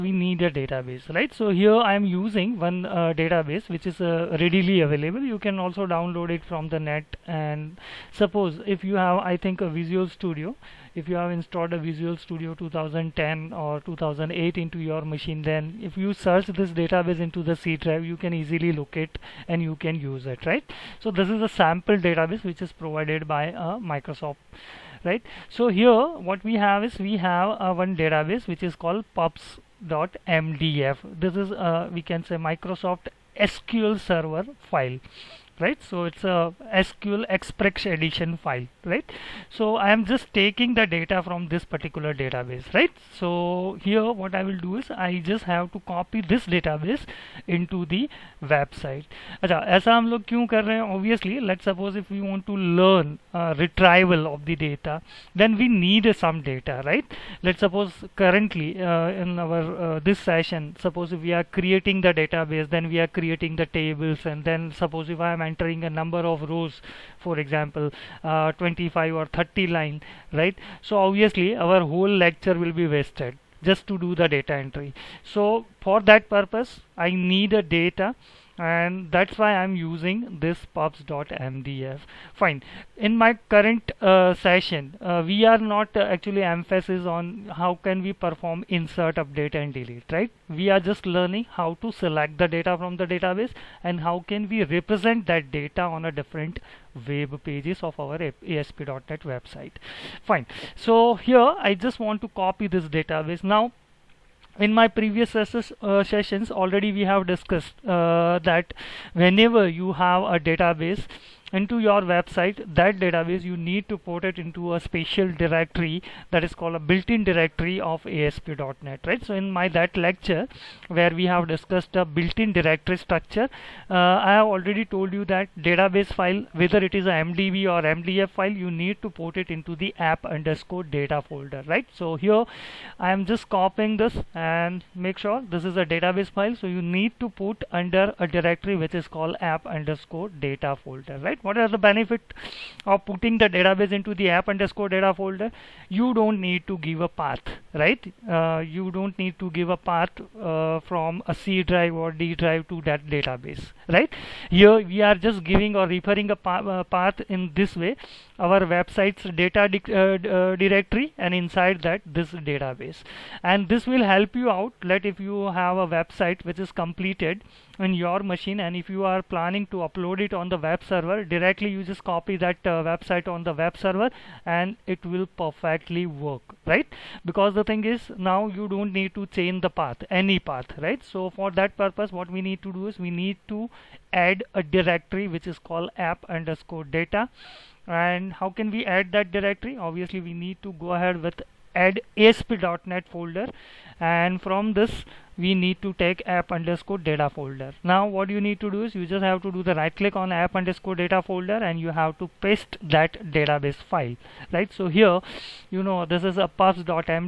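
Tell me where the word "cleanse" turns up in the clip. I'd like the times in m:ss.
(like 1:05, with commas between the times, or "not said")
not said.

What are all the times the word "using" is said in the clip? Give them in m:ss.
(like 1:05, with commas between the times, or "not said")
0:02, 1:19.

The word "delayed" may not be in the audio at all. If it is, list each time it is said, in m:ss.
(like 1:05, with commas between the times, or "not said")
not said.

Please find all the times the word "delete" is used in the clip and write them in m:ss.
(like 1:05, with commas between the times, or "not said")
1:29.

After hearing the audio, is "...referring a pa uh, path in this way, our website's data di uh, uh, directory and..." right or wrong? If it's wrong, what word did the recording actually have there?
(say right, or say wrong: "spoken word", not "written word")
right.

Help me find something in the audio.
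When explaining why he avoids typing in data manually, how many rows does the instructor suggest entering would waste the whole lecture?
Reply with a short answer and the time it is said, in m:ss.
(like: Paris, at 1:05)
25 or 30, at 1:08.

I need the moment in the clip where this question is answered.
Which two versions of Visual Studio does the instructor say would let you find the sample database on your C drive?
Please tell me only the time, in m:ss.
0:12.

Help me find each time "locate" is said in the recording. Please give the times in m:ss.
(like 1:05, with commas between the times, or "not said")
0:18.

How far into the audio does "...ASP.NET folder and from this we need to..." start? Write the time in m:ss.
3:12.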